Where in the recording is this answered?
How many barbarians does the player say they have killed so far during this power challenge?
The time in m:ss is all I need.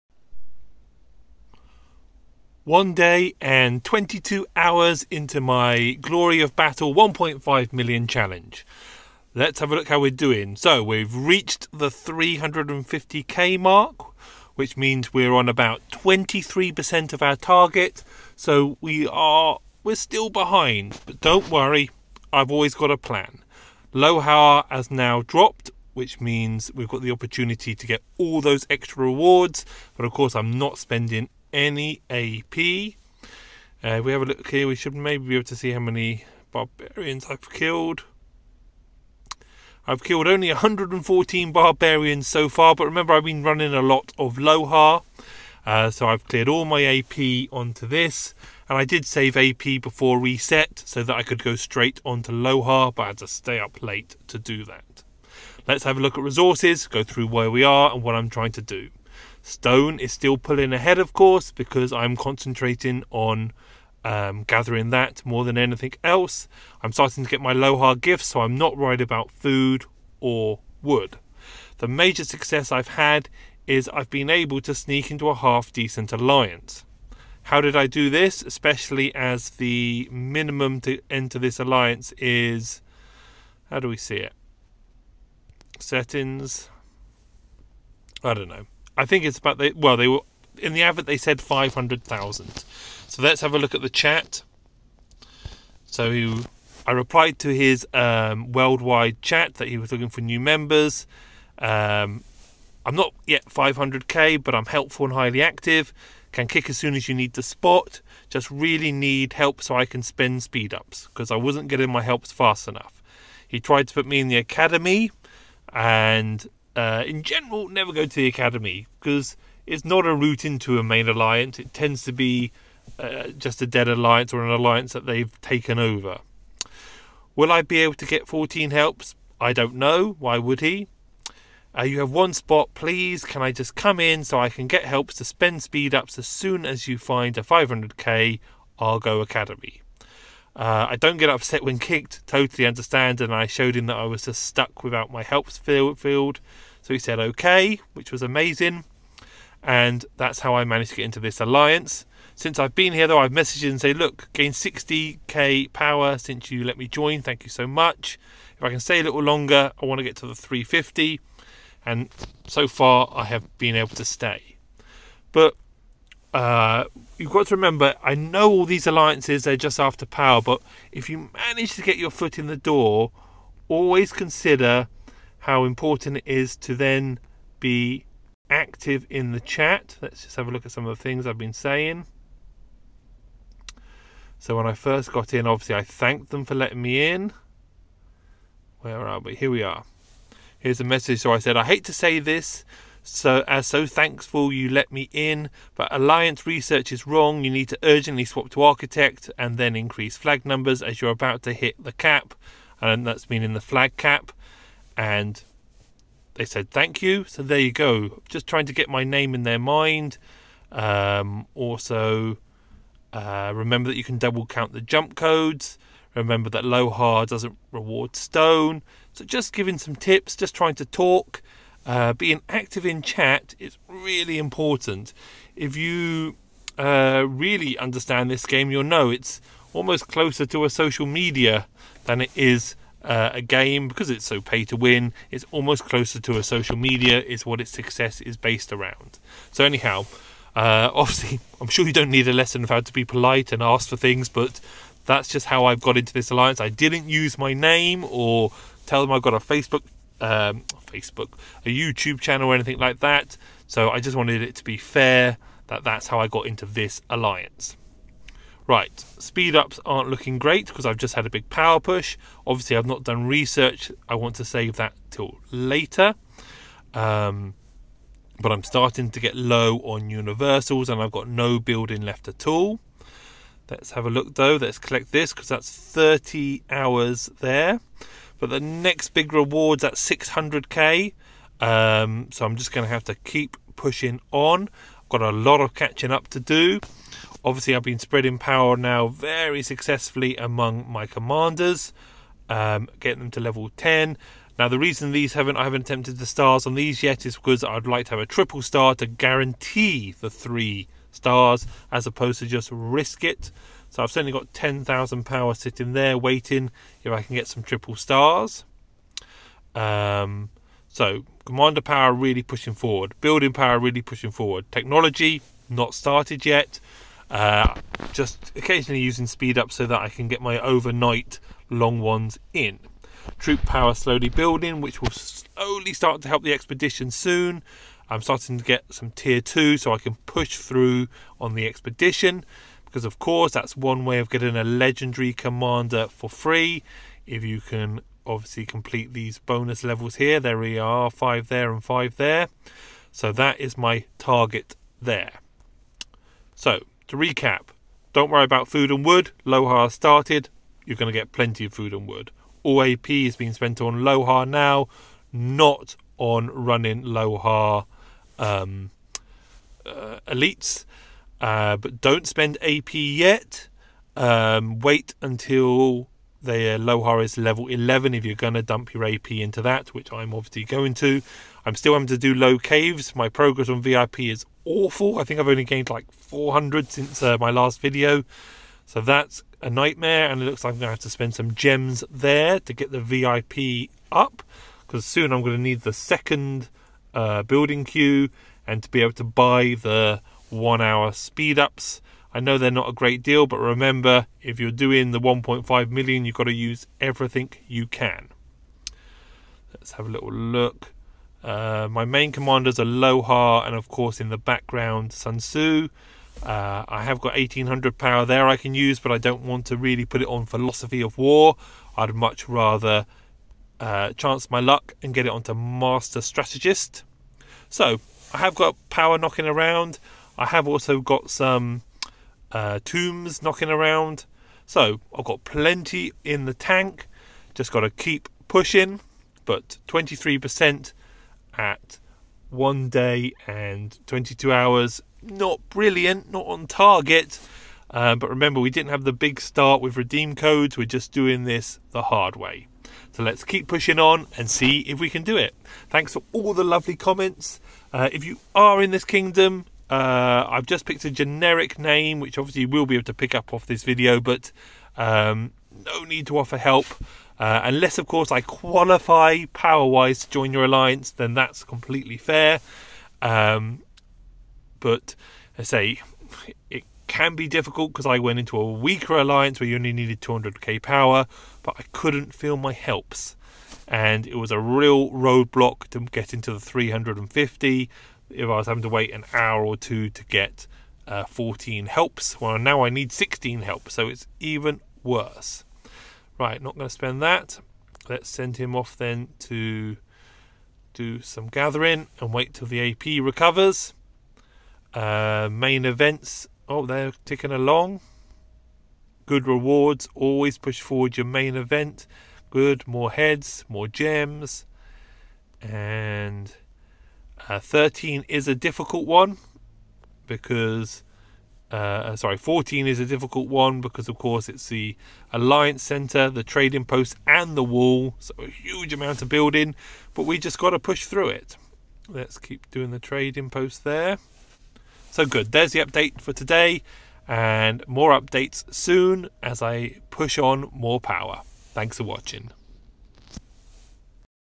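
0:40.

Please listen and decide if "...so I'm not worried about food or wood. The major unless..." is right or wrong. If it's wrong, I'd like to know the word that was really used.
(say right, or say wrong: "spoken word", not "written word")
wrong: "success", not "unless".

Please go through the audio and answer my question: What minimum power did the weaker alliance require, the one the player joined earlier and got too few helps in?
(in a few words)
200k.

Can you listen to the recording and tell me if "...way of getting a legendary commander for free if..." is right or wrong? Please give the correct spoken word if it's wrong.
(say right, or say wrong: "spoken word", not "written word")
right.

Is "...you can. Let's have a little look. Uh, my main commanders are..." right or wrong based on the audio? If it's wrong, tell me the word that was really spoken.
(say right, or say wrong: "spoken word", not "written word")
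right.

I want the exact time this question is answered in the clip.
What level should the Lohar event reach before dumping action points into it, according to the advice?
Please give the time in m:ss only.
6:07.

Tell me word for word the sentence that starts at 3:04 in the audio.
So when I first got in, obviously I thanked them for letting me in.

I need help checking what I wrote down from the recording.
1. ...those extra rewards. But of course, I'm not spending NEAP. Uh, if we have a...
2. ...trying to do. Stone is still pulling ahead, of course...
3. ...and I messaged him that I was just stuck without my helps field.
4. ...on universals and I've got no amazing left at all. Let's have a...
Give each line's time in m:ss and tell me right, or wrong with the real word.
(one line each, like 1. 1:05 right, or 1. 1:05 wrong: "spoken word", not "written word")
1. 0:28 right
2. 0:58 right
3. 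2:23 wrong: "showed", not "messaged"
4. 4:29 wrong: "building", not "amazing".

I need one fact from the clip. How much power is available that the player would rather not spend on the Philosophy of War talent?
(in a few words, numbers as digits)
1800.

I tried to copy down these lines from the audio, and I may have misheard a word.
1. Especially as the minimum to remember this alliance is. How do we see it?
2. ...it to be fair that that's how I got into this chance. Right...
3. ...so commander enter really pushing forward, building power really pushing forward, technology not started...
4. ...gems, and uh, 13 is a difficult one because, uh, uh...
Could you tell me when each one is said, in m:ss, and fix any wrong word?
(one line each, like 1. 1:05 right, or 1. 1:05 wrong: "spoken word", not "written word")
1. 1:18 wrong: "enter", not "remember"
2. 4:14 wrong: "alliance", not "chance"
3. 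5:10 wrong: "power", not "enter"
4. 8:23 right.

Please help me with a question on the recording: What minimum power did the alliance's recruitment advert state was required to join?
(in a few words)
500,000.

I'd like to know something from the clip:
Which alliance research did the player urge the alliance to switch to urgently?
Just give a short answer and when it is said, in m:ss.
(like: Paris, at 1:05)
Architect, at 3:18.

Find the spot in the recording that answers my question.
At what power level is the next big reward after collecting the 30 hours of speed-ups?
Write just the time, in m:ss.
4:39.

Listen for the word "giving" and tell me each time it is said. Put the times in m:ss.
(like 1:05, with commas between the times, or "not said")
3:39.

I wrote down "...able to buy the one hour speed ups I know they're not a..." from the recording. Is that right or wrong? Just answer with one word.
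right.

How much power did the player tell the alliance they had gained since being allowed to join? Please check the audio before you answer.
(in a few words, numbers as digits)
60k.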